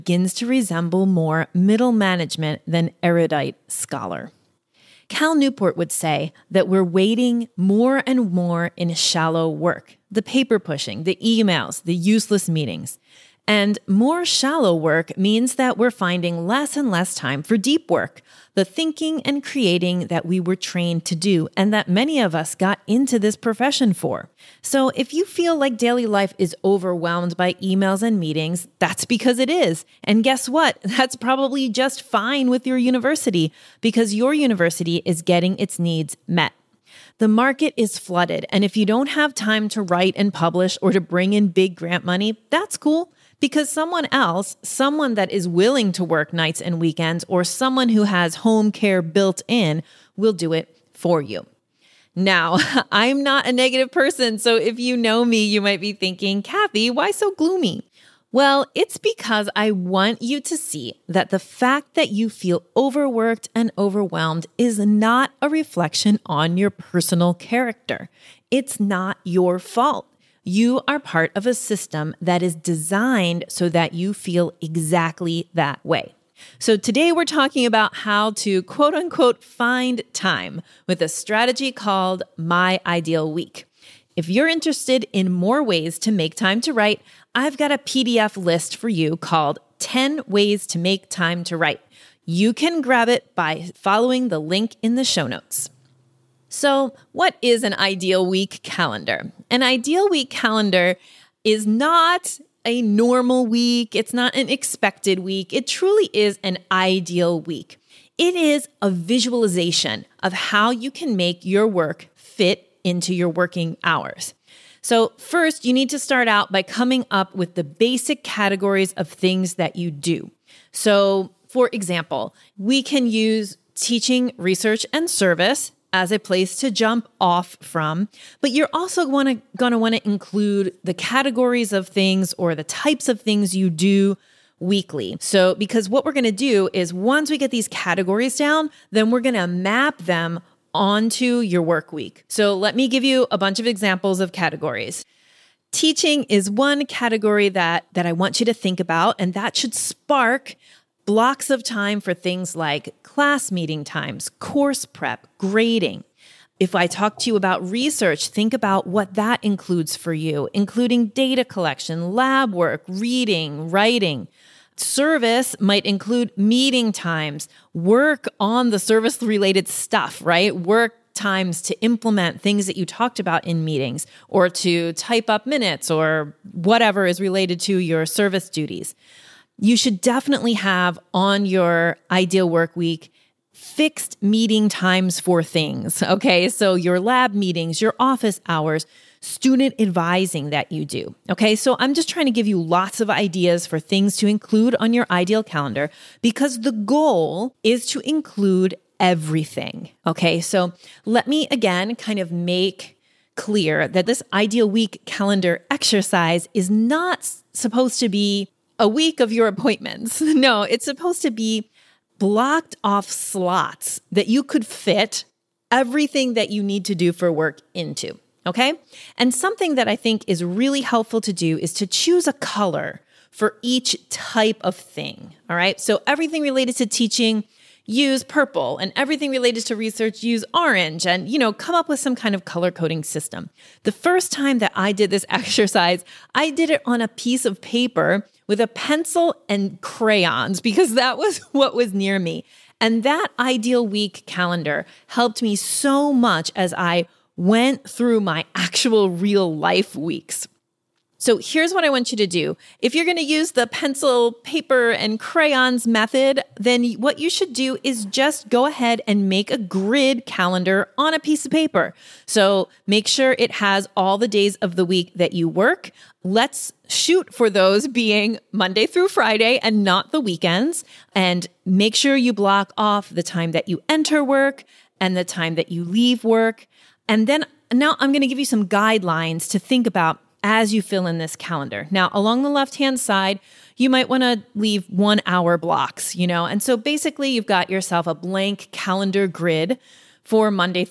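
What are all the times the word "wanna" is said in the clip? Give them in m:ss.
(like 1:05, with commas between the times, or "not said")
2:09.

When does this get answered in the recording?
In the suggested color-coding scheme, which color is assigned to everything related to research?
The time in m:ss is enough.
3:50.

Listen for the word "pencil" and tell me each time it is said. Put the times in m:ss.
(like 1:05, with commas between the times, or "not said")
3:58, 4:13.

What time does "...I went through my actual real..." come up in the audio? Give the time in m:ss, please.
4:06.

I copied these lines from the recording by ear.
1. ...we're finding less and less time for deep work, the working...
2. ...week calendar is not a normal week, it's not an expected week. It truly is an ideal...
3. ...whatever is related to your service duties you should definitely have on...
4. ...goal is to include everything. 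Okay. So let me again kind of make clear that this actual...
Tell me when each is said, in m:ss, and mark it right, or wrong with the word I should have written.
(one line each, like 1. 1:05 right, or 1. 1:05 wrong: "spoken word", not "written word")
1. 0:15 wrong: "thinking", not "working"
2. 1:40 right
3. 2:56 right
4. 3:16 wrong: "ideal", not "actual".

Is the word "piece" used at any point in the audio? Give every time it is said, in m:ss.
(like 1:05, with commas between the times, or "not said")
3:57, 4:21.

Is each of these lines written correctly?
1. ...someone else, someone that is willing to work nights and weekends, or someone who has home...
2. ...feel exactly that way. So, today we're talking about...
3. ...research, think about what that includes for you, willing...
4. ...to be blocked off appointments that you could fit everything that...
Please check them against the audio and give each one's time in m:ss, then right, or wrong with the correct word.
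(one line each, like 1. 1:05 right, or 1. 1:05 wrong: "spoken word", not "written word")
1. 0:43 right
2. 1:14 right
3. 2:37 wrong: "including", not "willing"
4. 3:31 wrong: "slots", not "appointments".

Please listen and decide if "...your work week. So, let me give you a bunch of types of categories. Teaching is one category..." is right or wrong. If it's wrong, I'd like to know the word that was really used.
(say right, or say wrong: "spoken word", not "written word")
wrong: "examples", not "types".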